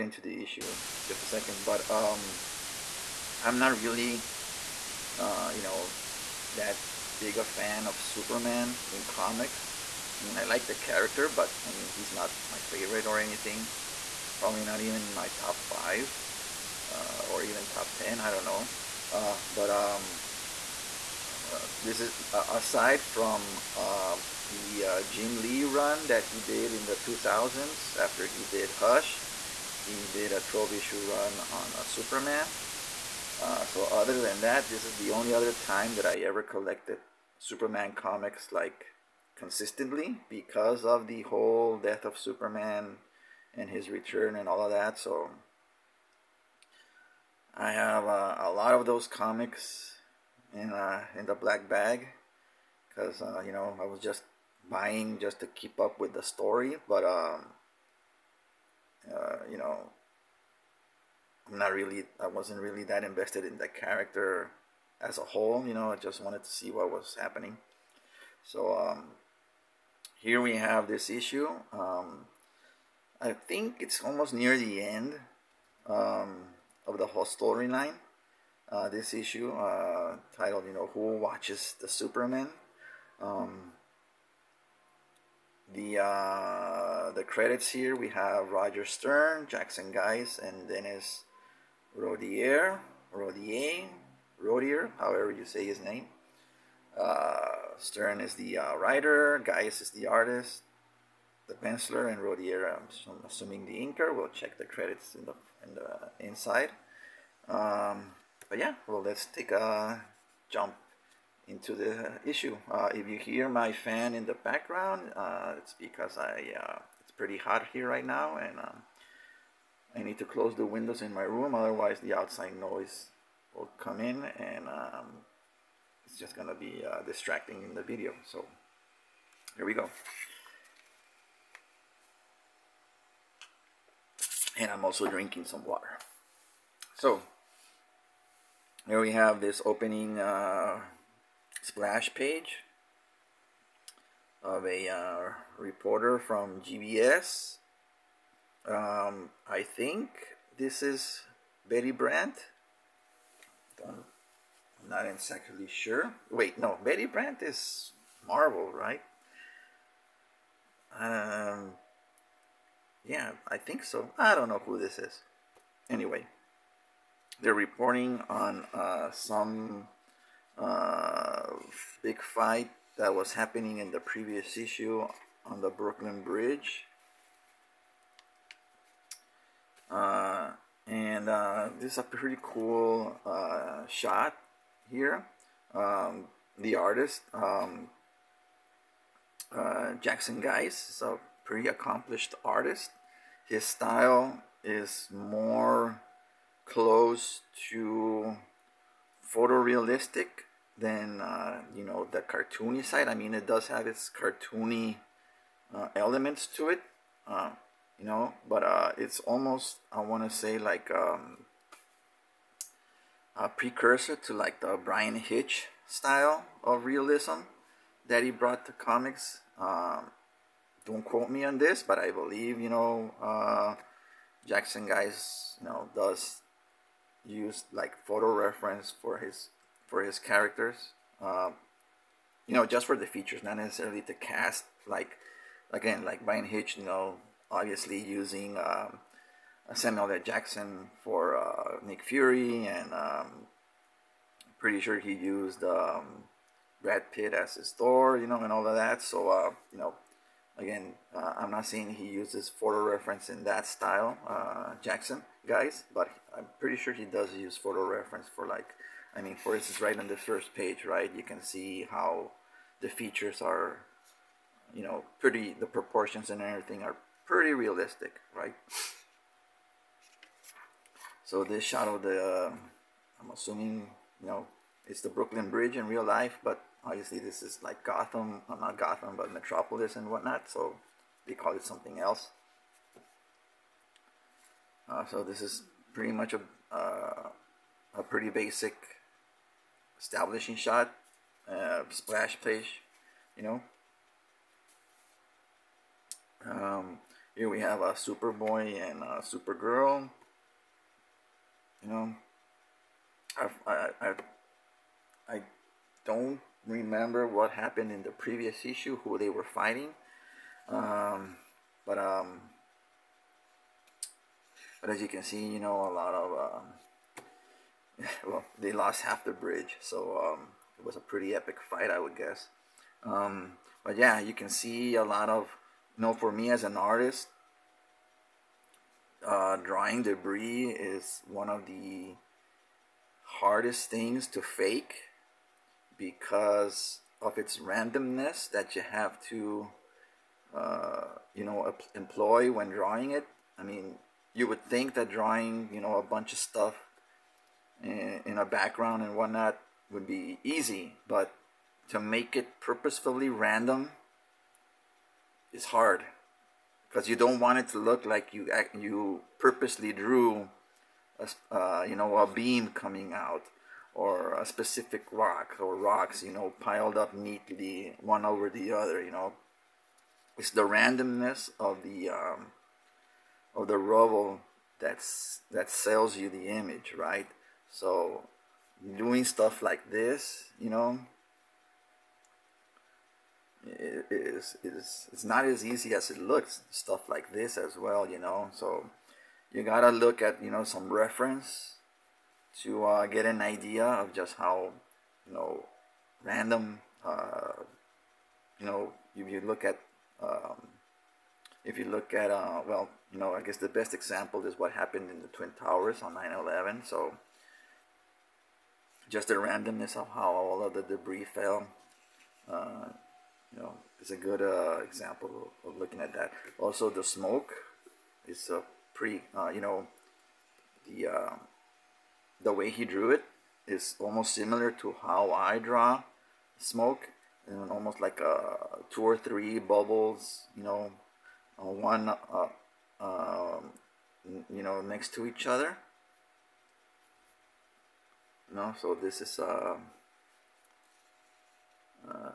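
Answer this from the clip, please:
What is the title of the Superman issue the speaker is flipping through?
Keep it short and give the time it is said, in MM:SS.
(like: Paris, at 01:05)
Who Watches the Superman?, at 01:20.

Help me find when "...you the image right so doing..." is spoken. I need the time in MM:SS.
06:16.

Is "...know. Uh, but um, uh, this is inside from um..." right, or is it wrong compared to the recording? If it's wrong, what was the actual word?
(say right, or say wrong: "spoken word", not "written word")
wrong: "aside", not "inside".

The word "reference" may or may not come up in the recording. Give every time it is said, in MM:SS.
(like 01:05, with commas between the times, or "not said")
03:48, 04:12, 04:17, 06:30.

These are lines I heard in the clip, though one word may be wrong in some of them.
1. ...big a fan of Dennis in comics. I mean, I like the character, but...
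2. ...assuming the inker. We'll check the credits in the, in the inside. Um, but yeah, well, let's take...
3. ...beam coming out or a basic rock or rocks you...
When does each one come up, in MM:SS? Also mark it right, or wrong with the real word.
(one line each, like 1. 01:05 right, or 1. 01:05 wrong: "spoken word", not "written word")
1. 00:07 wrong: "Superman", not "Dennis"
2. 01:43 right
3. 06:02 wrong: "specific", not "basic".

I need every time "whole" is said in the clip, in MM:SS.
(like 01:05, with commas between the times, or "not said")
00:41, 01:05, 01:17.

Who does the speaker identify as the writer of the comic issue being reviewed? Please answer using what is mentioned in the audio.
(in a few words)
Roger Stern.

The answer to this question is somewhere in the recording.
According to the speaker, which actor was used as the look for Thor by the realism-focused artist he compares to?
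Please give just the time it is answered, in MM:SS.
04:06.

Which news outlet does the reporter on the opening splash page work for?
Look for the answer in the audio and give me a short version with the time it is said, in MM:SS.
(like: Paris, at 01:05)
GBS, at 02:26.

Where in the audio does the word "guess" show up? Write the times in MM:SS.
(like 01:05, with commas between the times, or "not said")
05:22, 06:43.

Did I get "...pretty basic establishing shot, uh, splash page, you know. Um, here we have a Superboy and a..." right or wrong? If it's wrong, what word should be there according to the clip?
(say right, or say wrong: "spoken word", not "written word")
right.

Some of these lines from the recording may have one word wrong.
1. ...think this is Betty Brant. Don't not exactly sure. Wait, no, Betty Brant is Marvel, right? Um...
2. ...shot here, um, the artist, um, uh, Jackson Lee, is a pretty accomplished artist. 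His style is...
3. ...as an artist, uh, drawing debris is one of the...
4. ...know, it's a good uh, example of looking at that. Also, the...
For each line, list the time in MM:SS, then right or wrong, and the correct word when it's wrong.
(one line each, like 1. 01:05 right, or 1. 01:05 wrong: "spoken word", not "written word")
1. 02:29 right
2. 03:03 wrong: "Guice", not "Lee"
3. 05:26 right
4. 06:53 right.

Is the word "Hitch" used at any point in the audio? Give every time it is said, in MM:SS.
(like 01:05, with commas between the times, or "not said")
03:35, 03:56.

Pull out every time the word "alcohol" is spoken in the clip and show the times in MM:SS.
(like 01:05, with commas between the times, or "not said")
not said.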